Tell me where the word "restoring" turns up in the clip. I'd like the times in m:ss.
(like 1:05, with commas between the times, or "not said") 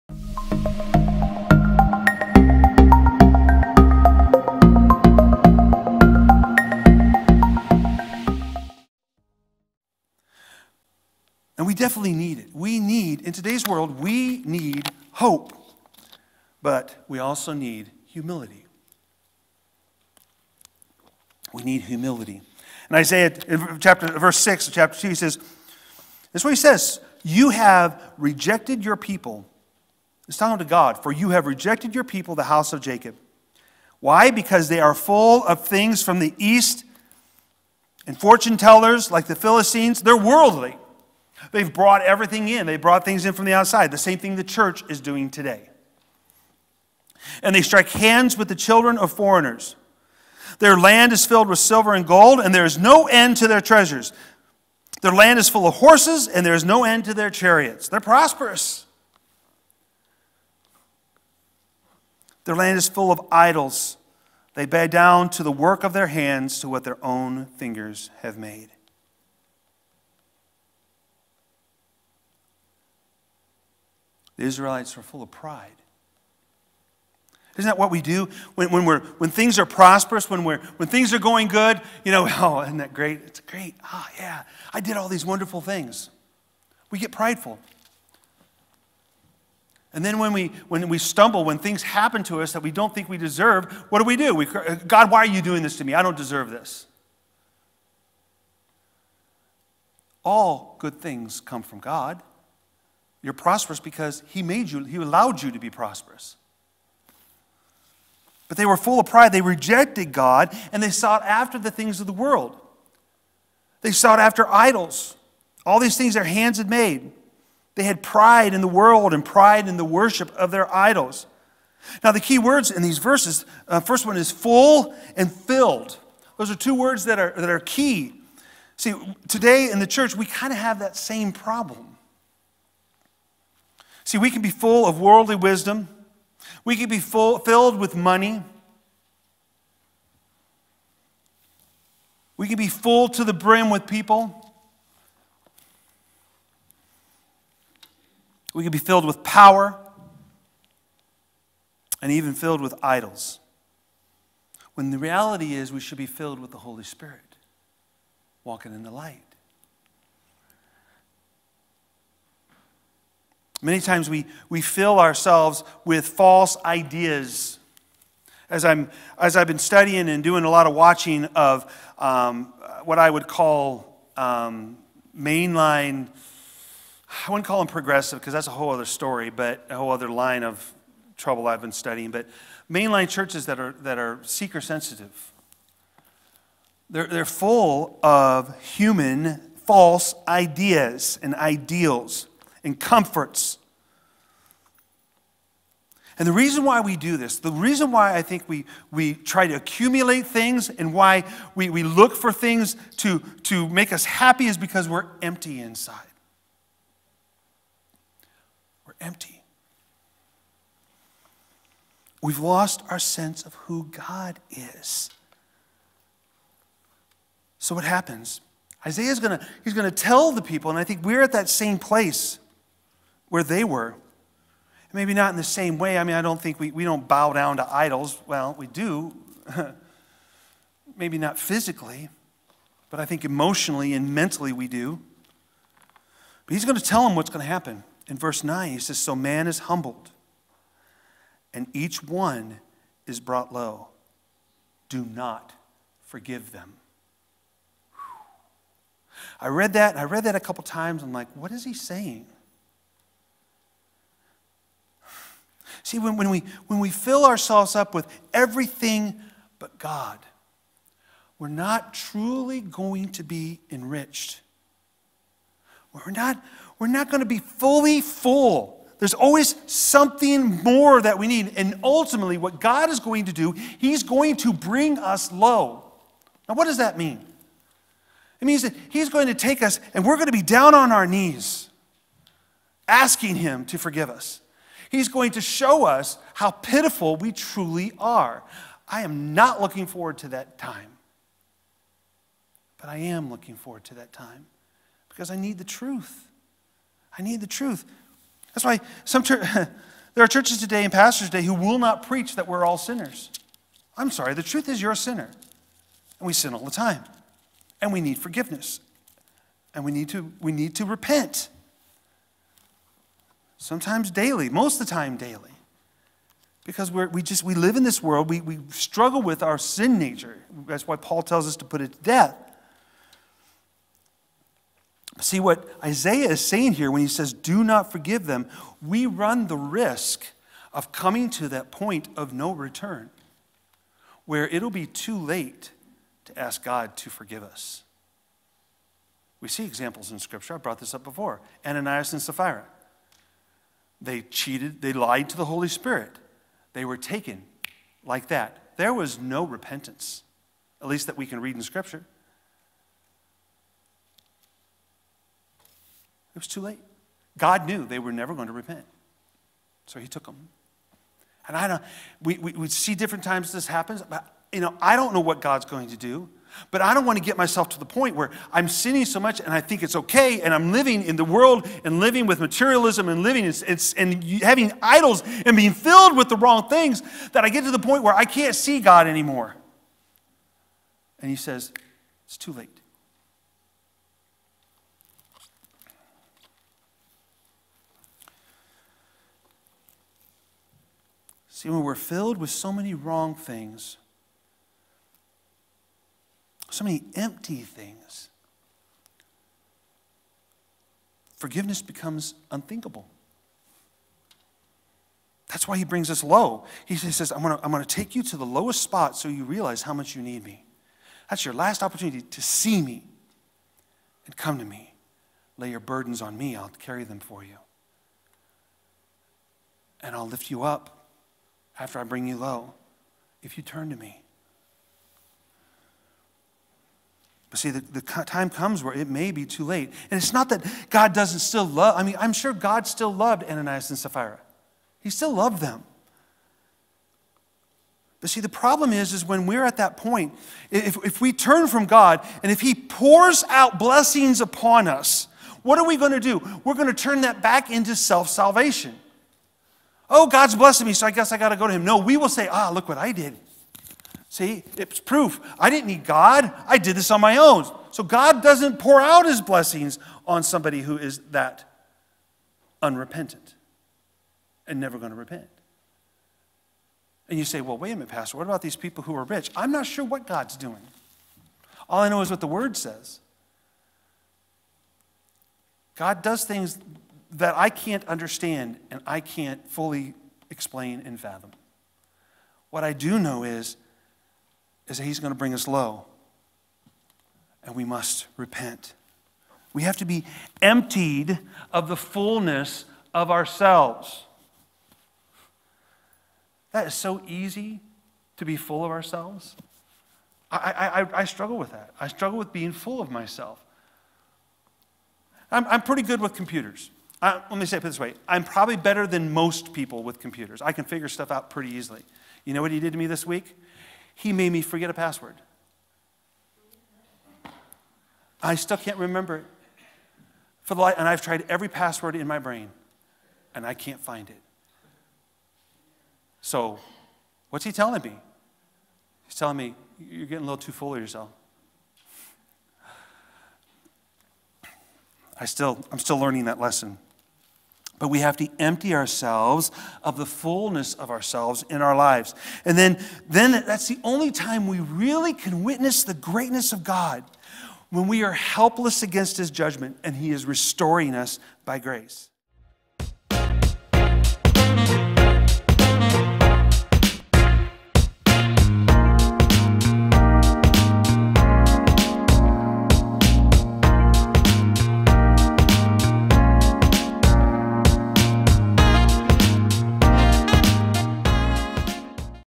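9:10.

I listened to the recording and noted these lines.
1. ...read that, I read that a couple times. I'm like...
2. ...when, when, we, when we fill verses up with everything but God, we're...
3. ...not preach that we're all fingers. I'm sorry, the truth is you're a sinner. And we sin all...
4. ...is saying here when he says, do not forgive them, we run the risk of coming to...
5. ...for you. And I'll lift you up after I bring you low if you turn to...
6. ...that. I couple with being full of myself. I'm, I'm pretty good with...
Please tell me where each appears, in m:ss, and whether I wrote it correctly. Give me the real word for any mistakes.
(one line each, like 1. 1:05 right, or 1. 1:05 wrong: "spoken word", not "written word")
1. 4:09 right
2. 4:15 wrong: "ourselves", not "verses"
3. 5:01 wrong: "sinners", not "fingers"
4. 5:26 right
5. 6:57 right
6. 8:21 wrong: "struggle", not "couple".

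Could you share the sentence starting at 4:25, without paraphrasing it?
We're not, we're not going to be fully full.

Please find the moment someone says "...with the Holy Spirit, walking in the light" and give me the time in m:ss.
2:36.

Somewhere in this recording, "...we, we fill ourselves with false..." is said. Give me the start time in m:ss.
2:44.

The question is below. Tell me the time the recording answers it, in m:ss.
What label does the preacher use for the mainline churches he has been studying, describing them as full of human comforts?
3:04.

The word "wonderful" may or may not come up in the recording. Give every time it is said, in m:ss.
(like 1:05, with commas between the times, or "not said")
1:25.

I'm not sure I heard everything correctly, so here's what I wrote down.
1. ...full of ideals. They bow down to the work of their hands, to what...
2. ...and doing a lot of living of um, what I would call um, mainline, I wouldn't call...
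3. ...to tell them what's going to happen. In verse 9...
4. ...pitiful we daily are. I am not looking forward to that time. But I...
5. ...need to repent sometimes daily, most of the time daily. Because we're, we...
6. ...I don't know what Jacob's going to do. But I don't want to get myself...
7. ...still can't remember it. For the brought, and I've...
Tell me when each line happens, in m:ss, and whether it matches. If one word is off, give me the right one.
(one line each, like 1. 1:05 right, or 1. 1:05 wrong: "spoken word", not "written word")
1. 1:02 wrong: "idols", not "ideals"
2. 2:50 wrong: "watching", not "living"
3. 3:56 right
4. 4:46 wrong: "truly", not "daily"
5. 5:10 right
6. 6:04 wrong: "God", not "Jacob"
7. 8:38 wrong: "light", not "brought".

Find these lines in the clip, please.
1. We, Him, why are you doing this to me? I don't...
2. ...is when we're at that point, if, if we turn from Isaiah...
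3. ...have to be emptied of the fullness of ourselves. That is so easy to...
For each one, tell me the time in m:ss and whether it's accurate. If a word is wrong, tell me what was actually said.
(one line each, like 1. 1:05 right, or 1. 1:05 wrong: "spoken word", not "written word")
1. 1:34 wrong: "God", not "Him"
2. 7:19 wrong: "God", not "Isaiah"
3. 8:09 right.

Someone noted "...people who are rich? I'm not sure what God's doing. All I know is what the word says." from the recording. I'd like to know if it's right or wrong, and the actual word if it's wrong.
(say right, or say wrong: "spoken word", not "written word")
right.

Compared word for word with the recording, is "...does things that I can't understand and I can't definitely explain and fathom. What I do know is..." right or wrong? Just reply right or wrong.
wrong.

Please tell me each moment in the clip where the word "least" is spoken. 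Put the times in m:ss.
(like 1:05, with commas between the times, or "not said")
5:50.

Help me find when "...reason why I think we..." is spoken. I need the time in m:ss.
3:17.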